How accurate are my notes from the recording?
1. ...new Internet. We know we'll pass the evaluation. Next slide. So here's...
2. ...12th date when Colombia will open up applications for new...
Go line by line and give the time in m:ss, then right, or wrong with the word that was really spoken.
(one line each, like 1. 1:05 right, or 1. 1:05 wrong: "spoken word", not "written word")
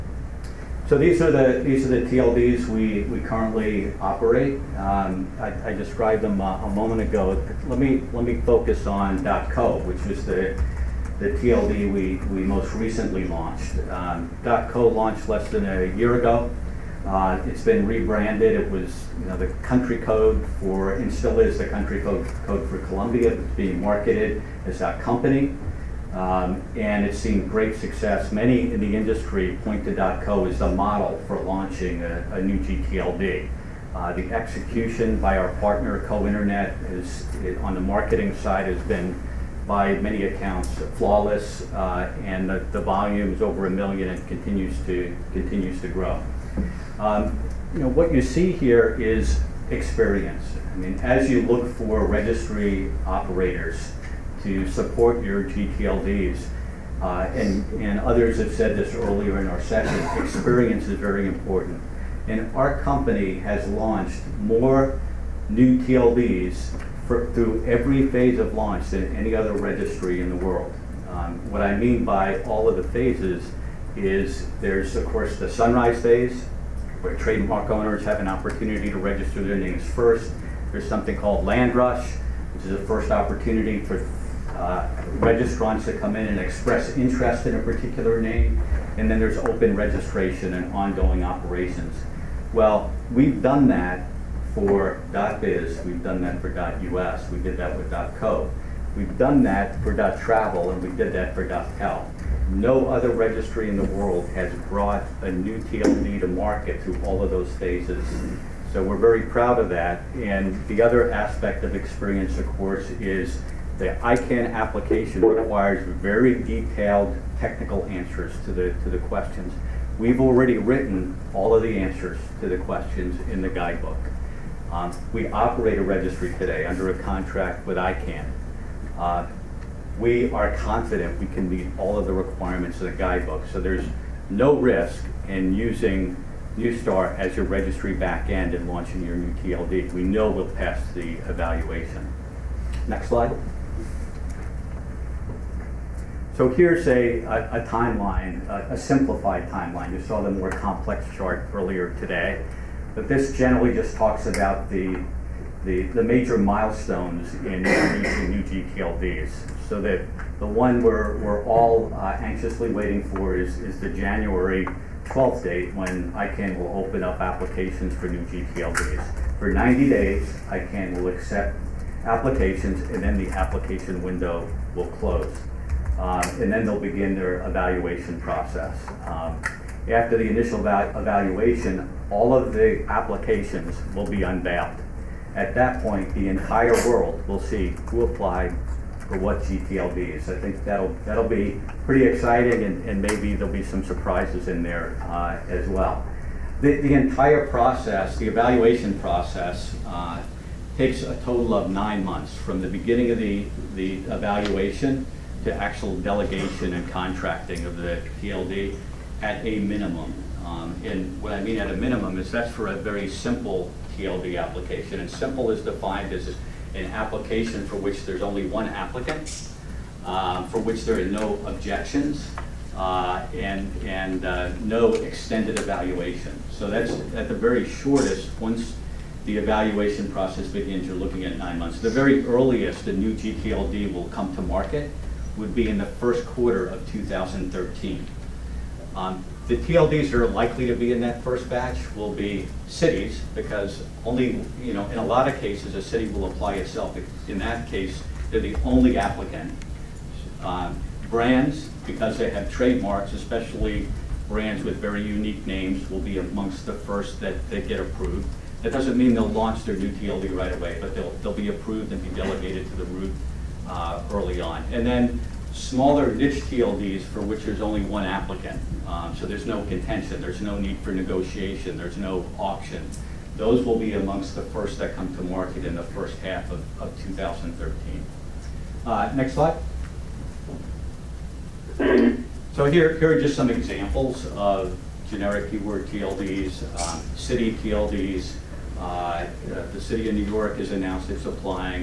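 1. 2:19 wrong: "TLD", not "Internet"
2. 2:45 wrong: "ICANN", not "Colombia".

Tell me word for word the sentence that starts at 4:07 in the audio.
In that case, they're the only applicant.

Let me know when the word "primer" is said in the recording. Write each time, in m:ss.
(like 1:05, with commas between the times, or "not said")
not said.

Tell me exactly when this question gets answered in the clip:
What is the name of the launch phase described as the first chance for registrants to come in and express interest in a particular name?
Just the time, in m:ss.
1:21.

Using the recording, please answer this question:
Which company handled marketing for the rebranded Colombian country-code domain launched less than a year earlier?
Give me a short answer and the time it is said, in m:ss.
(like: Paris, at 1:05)
Co Internet, at 0:36.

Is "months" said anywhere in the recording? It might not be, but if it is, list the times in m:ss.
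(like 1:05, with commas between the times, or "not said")
3:22, 3:51.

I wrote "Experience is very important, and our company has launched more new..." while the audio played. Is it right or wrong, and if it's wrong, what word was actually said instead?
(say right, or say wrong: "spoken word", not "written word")
right.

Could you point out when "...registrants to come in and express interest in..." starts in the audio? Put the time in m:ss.
1:25.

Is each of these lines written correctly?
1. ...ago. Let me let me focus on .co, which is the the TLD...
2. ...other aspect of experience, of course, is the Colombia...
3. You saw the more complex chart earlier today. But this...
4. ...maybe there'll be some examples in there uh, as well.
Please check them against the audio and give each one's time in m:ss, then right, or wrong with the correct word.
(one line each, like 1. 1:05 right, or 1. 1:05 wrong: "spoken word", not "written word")
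1. 0:07 right
2. 1:50 wrong: "ICANN", not "Colombia"
3. 2:29 right
4. 3:13 wrong: "surprises", not "examples".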